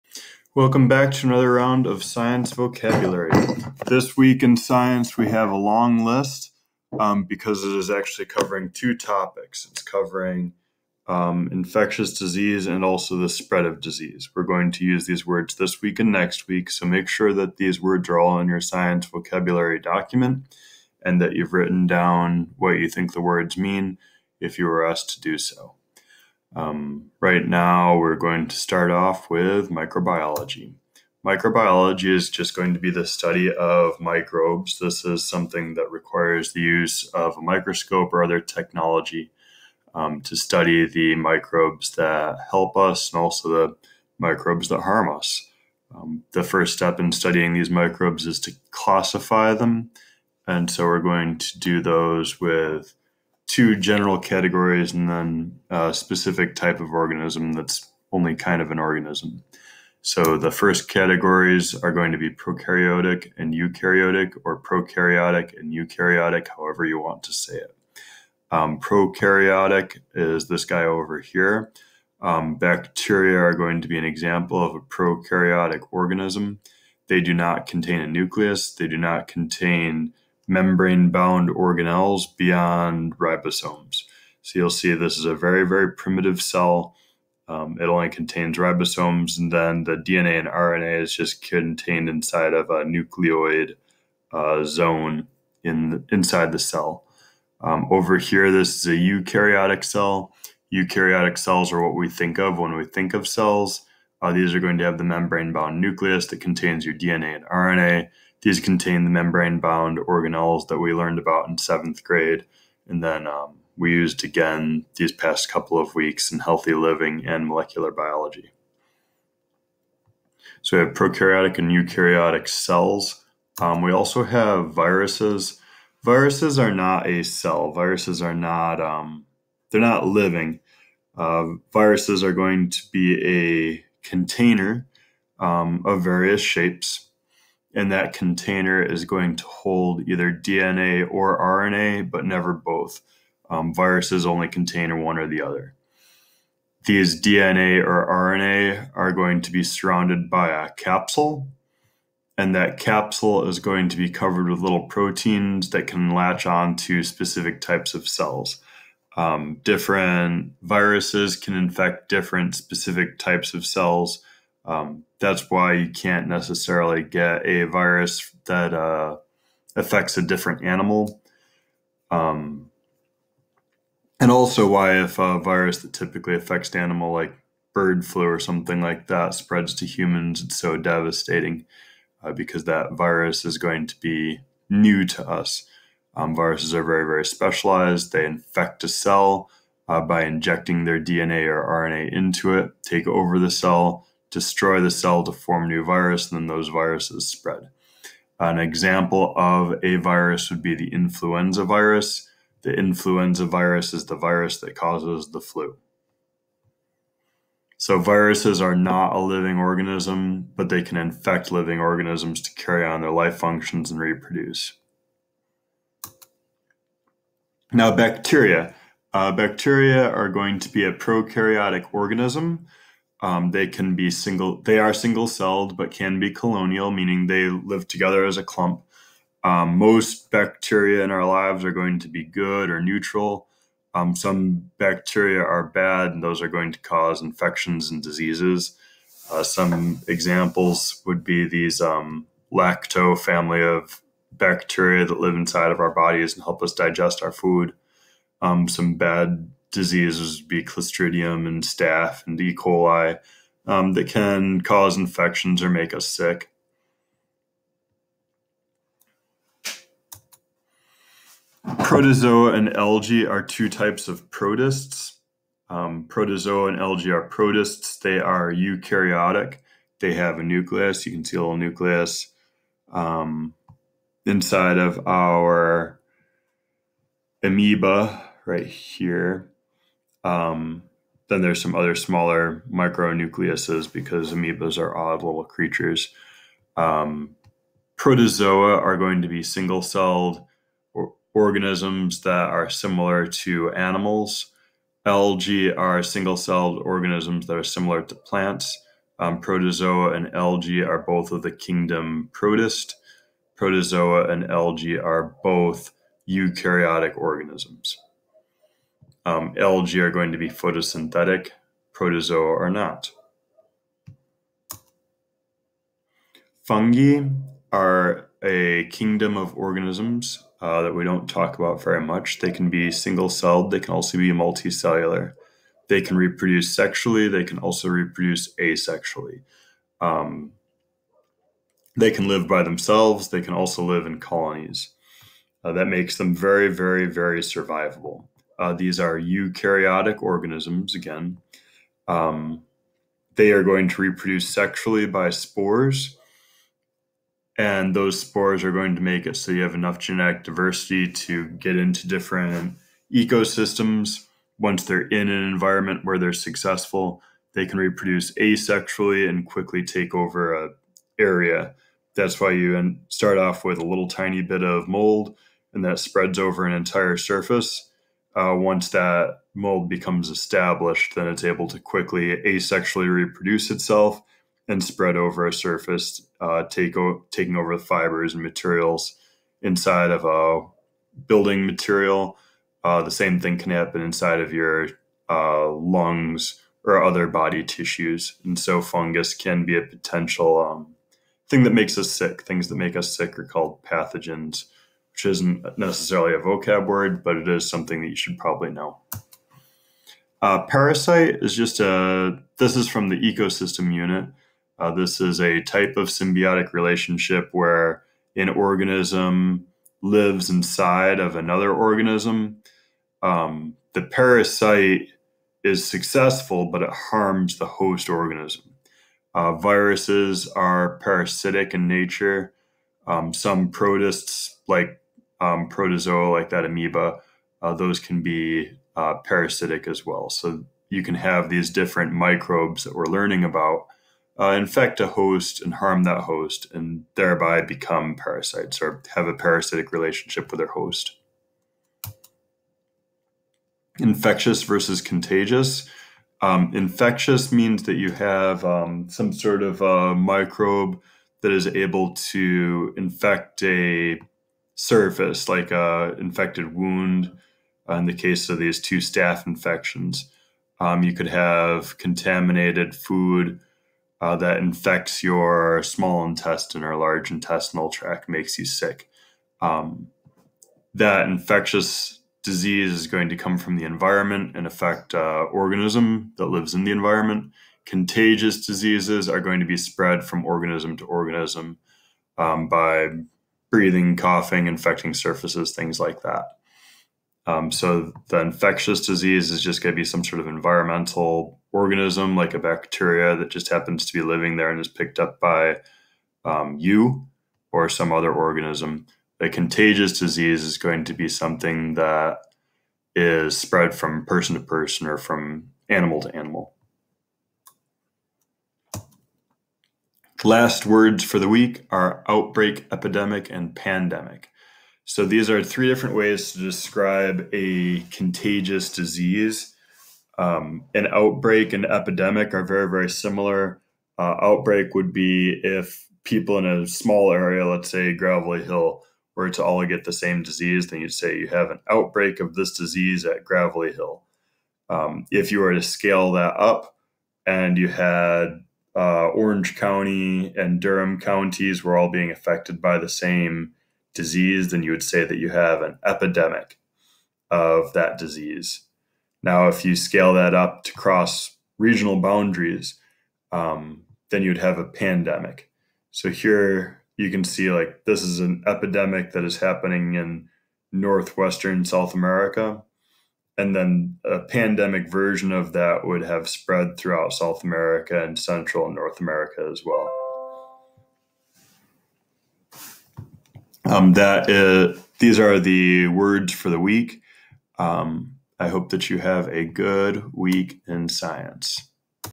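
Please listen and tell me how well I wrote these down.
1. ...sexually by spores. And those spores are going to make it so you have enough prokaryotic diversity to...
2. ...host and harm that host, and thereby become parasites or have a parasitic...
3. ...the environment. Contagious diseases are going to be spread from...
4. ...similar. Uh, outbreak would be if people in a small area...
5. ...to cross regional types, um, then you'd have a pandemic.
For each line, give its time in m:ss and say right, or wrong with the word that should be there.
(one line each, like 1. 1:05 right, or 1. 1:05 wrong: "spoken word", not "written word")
1. 5:44 wrong: "genetic", not "prokaryotic"
2. 7:15 right
3. 7:56 right
4. 8:43 right
5. 9:10 wrong: "boundaries", not "types".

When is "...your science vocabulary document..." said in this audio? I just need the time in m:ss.
0:18.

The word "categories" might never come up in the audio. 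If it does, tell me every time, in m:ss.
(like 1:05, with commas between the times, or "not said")
0:54, 1:00.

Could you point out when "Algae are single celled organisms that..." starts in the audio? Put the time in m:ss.
4:55.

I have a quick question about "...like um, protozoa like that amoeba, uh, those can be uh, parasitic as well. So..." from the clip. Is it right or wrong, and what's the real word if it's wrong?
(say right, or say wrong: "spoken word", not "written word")
right.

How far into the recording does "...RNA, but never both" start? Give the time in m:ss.
2:21.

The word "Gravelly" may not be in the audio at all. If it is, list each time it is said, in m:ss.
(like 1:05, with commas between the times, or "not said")
8:48, 8:53.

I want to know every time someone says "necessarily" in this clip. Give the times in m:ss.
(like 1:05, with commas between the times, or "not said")
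2:46, 6:35.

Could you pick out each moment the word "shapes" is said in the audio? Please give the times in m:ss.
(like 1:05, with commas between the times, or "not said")
2:16.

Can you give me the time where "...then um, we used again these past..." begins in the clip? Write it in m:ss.
1:53.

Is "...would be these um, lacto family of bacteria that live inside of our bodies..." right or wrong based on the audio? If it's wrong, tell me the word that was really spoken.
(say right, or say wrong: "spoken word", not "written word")
right.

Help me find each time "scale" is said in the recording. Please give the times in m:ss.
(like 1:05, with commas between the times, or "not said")
8:55, 9:09.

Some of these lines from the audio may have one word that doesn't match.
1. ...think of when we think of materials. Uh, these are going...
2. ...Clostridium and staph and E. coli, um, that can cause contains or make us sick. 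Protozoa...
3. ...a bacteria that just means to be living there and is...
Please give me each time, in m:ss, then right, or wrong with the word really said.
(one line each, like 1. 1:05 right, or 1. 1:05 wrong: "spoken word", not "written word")
1. 1:42 wrong: "cells", not "materials"
2. 4:10 wrong: "infections", not "contains"
3. 8:12 wrong: "happens", not "means".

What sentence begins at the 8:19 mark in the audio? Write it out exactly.
The contagious disease is going to be something that is spread from person to person or from animal to animal.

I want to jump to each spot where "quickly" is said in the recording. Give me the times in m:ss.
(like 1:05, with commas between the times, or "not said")
5:59, 6:11.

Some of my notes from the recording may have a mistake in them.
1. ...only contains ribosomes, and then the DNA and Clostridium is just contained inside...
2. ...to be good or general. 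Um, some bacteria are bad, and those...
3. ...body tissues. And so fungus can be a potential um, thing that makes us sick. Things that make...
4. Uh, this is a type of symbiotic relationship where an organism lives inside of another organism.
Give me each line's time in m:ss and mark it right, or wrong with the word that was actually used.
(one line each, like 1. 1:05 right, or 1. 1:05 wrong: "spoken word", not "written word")
1. 1:27 wrong: "RNA", not "Clostridium"
2. 3:51 wrong: "neutral", not "general"
3. 6:27 right
4. 6:44 right.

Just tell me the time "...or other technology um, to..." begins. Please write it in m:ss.
0:38.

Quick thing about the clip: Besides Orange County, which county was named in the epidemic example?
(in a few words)
Durham.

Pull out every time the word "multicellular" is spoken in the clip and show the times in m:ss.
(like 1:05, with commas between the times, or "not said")
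5:24.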